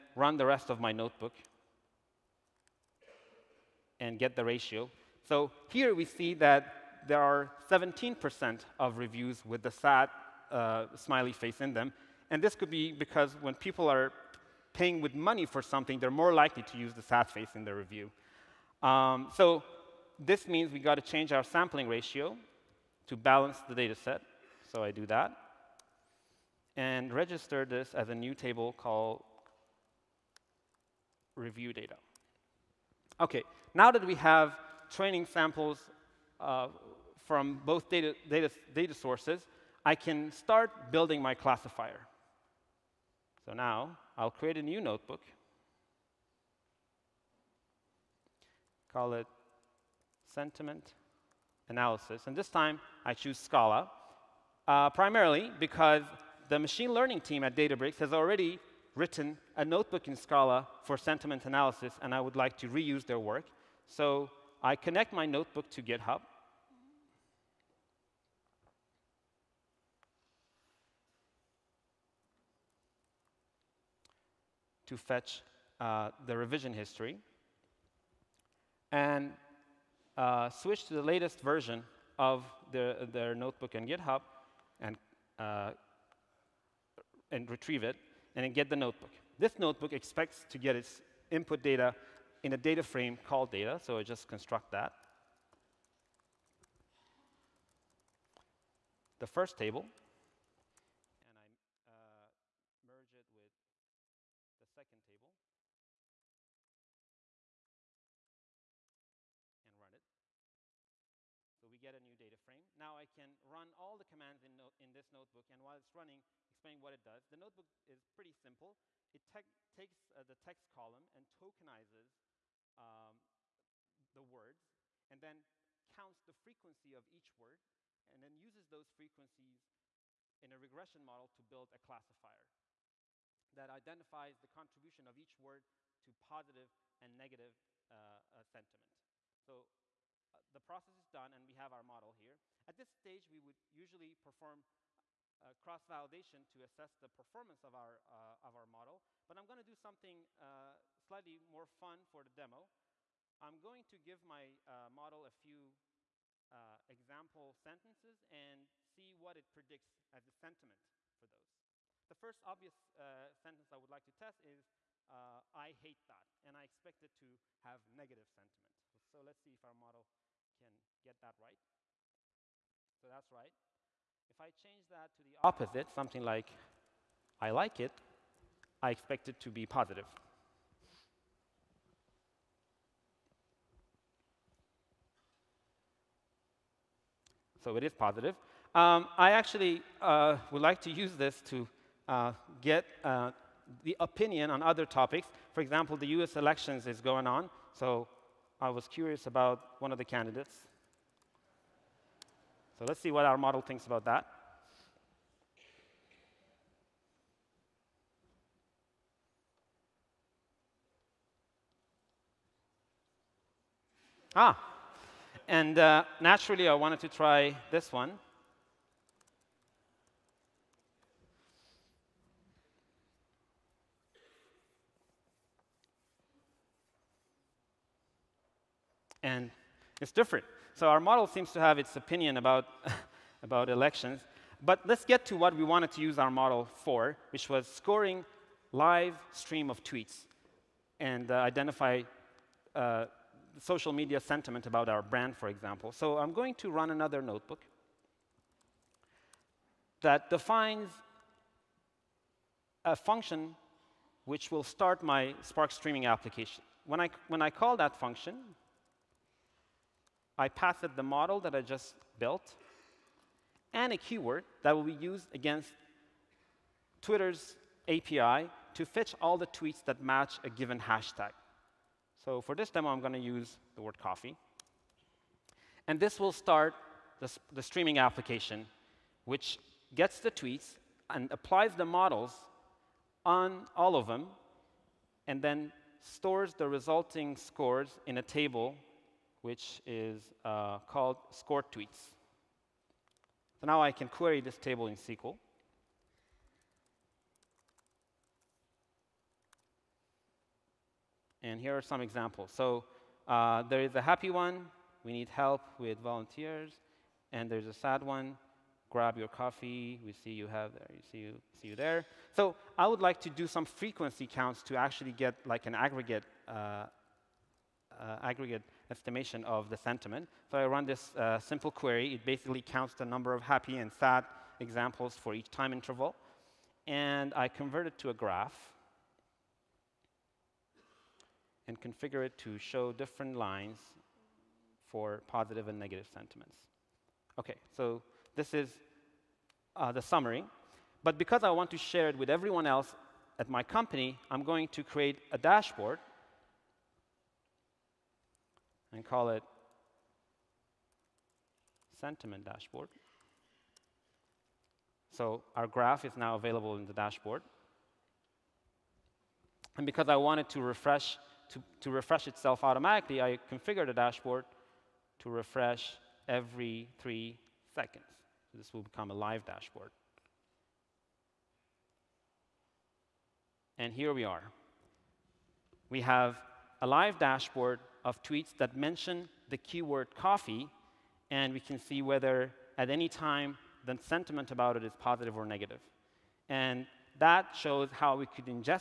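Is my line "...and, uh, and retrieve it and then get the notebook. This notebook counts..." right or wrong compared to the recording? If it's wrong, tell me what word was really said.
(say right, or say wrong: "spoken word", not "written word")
wrong: "expects", not "counts".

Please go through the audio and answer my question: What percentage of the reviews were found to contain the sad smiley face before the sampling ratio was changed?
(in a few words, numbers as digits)
17%.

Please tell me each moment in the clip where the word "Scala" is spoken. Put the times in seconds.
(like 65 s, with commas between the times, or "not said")
53 s, 60 s.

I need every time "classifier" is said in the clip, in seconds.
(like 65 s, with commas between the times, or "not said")
41 s, 131 s.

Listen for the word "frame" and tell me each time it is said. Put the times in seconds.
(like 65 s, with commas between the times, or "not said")
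92 s, 112 s.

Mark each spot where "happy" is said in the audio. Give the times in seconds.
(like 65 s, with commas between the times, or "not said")
304 s, 323 s.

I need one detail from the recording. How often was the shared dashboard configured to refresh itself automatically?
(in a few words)
every 3 seconds.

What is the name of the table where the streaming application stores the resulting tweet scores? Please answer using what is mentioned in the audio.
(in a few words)
score tweets.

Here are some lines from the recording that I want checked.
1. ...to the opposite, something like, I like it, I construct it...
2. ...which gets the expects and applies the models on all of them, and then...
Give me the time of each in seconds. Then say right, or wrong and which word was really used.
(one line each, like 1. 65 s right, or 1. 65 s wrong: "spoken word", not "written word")
1. 175 s wrong: "expect", not "construct"
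2. 279 s wrong: "tweets", not "expects".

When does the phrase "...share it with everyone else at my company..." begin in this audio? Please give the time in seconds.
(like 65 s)
341 s.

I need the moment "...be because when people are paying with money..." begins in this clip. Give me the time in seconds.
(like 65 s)
12 s.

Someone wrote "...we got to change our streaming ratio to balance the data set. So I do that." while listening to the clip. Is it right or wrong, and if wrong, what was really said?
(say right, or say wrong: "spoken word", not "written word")
wrong: "sampling", not "streaming".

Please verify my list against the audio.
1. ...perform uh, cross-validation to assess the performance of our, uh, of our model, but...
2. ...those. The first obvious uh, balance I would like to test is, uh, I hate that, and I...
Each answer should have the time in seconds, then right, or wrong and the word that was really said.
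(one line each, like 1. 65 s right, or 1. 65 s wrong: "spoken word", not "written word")
1. 144 s right
2. 161 s wrong: "sentence", not "balance".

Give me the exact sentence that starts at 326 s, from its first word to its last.
And I convert it to a graph and configure it to show different lines for positive and negative sentiments.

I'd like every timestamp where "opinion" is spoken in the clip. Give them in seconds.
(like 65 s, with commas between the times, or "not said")
194 s, 231 s.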